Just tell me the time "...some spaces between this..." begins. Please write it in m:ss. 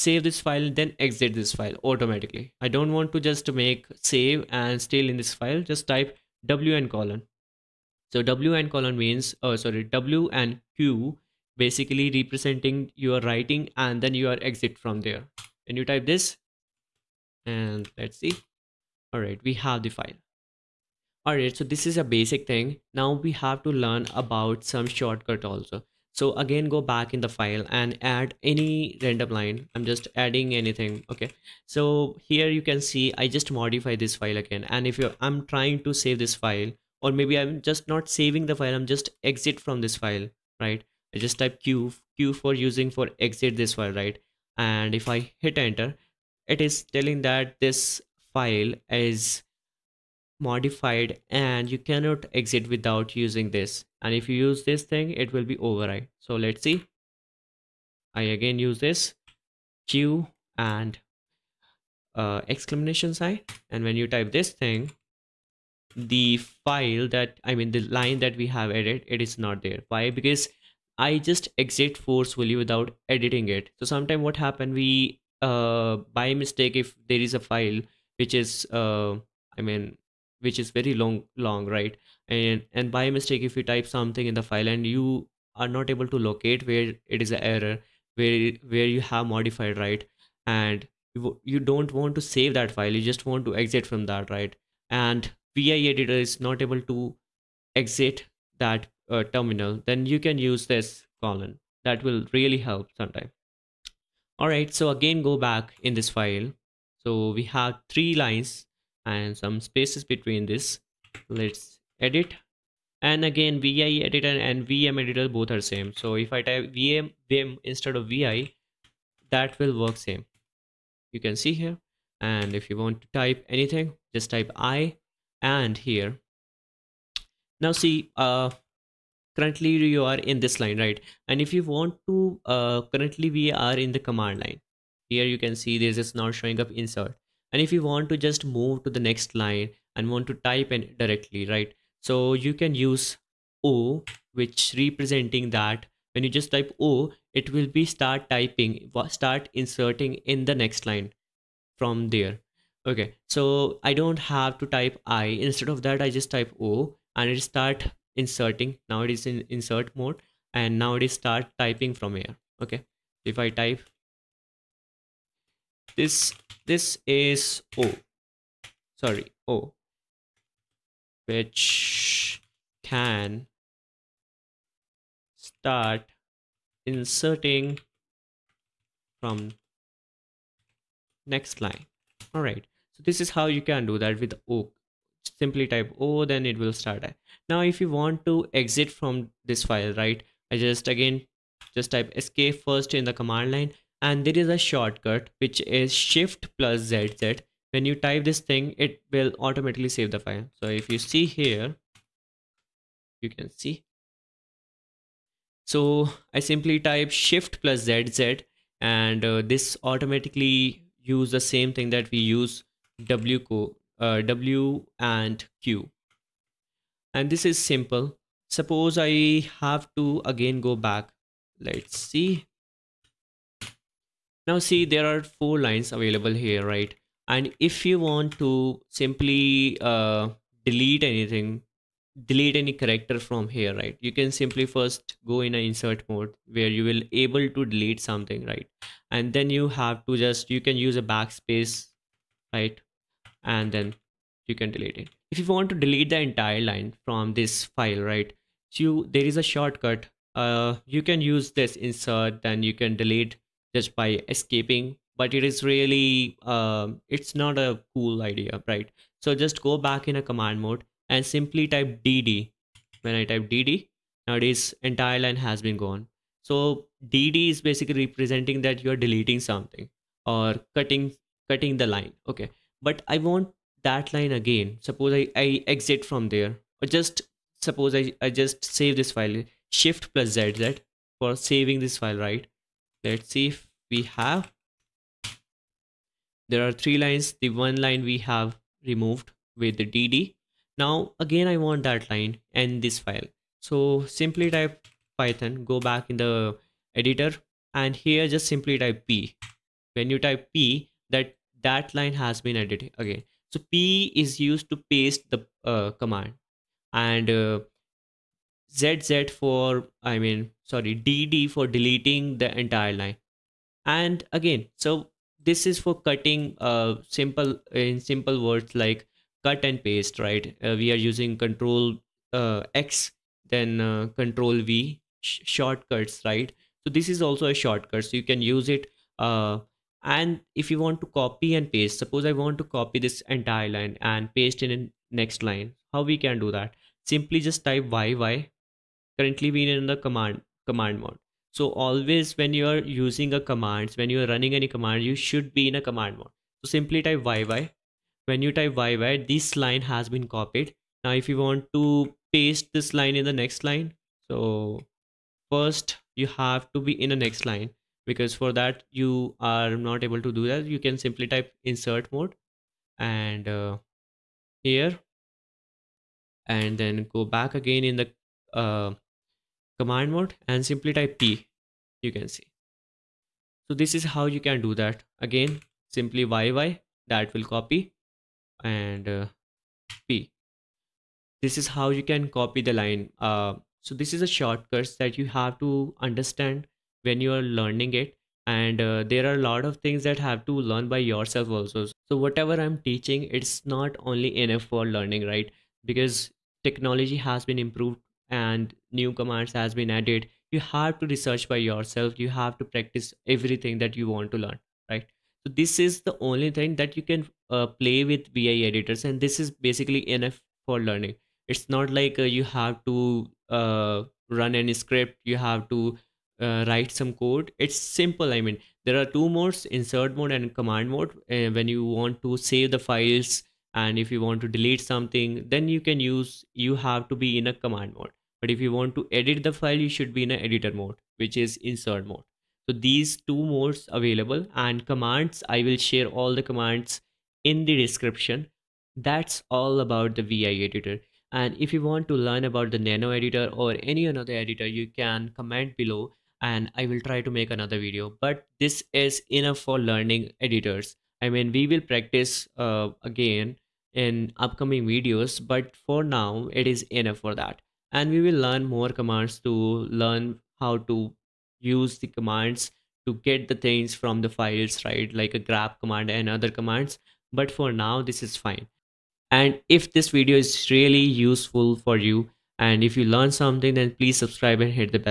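1:49.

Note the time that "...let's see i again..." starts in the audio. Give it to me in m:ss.
0:56.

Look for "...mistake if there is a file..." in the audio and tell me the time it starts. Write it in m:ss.
1:16.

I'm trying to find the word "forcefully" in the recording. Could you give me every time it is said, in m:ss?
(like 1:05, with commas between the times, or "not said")
1:12.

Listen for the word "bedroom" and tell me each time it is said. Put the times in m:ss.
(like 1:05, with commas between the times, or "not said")
not said.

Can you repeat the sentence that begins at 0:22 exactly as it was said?
Now we have to learn about some shortcut also.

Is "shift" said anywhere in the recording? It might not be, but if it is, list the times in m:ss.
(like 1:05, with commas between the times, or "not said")
3:15, 3:27, 4:39.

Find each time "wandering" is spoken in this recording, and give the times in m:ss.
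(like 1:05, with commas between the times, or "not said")
not said.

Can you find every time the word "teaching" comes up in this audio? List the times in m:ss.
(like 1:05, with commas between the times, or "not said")
6:32.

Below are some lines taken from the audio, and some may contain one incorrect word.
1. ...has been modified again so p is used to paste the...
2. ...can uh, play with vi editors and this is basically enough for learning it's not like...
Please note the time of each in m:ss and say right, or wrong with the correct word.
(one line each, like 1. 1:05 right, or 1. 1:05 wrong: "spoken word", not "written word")
1. 5:02 wrong: "edited", not "modified"
2. 6:47 right.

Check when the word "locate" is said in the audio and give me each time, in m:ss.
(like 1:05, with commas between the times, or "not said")
1:26.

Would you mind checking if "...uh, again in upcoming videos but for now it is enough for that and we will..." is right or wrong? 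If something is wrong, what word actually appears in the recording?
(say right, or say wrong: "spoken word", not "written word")
right.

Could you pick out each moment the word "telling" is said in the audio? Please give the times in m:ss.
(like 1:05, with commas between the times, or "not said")
0:46.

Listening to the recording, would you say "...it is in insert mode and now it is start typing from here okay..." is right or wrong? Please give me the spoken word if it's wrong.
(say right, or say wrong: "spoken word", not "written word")
right.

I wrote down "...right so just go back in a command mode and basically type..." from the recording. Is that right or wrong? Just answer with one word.
wrong.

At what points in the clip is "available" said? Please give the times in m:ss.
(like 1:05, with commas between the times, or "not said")
3:45, 7:13.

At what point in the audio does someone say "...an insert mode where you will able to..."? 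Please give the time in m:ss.
3:55.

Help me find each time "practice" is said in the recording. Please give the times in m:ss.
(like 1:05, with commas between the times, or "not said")
6:42, 7:31.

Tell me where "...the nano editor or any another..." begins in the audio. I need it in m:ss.
7:22.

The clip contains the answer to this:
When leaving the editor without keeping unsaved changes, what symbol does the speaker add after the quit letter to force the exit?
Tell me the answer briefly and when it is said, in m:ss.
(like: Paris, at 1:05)
Exclamation sign, at 1:02.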